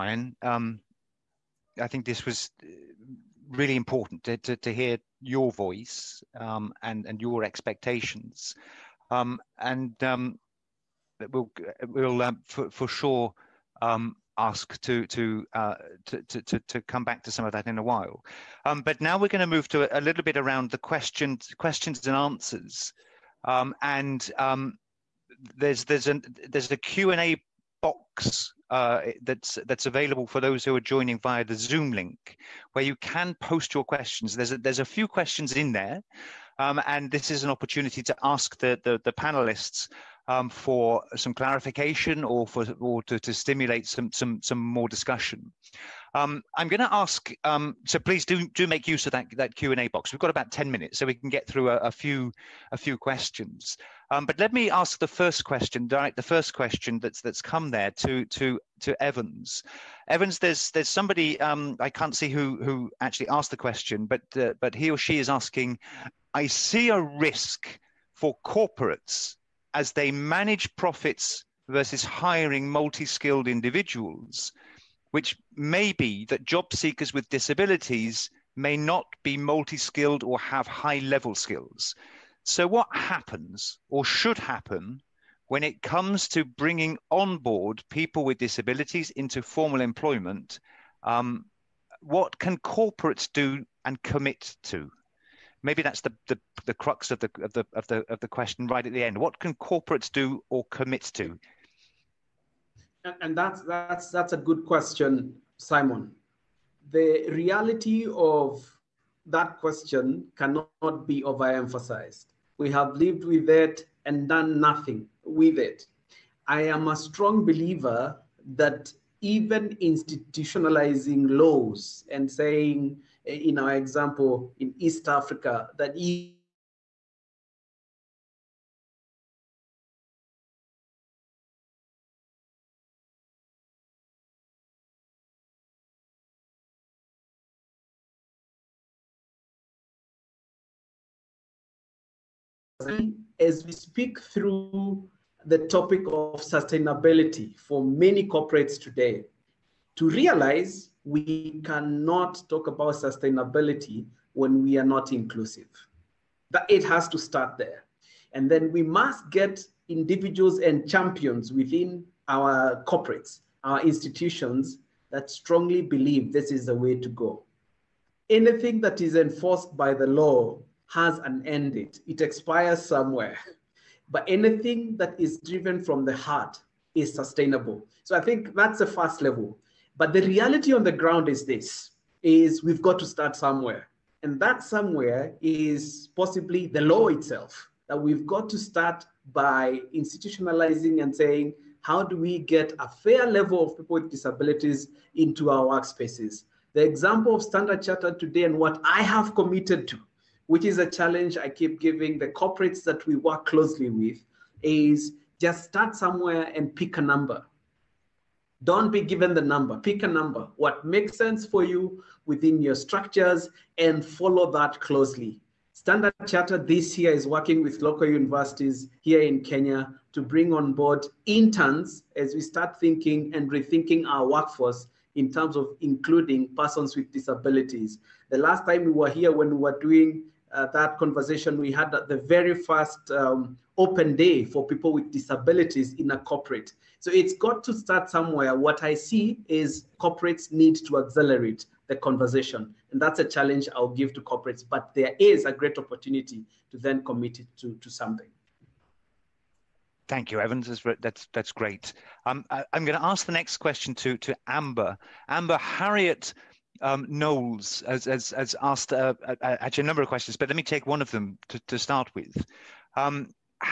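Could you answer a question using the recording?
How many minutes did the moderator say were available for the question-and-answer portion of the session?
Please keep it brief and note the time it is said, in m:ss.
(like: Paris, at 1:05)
10, at 0:50.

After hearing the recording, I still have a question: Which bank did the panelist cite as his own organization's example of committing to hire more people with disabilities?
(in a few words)
Standard Chartered.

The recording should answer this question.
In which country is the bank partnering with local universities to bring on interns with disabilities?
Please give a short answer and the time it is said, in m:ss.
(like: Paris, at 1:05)
Kenya, at 3:39.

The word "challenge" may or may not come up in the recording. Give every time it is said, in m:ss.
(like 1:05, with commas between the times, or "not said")
3:20, 4:03.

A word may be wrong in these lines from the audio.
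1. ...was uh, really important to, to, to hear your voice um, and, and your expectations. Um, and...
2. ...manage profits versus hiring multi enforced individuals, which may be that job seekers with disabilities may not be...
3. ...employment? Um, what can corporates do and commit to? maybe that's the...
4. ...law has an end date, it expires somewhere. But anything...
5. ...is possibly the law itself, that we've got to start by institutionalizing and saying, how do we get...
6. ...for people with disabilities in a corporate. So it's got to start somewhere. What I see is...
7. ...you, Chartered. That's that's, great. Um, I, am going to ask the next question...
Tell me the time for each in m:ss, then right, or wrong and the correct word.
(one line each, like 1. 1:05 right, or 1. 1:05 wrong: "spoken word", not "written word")
1. 0:02 right
2. 1:10 wrong: "skilled", not "enforced"
3. 1:29 right
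4. 2:50 right
5. 3:05 right
6. 3:54 right
7. 4:10 wrong: "Evans", not "Chartered".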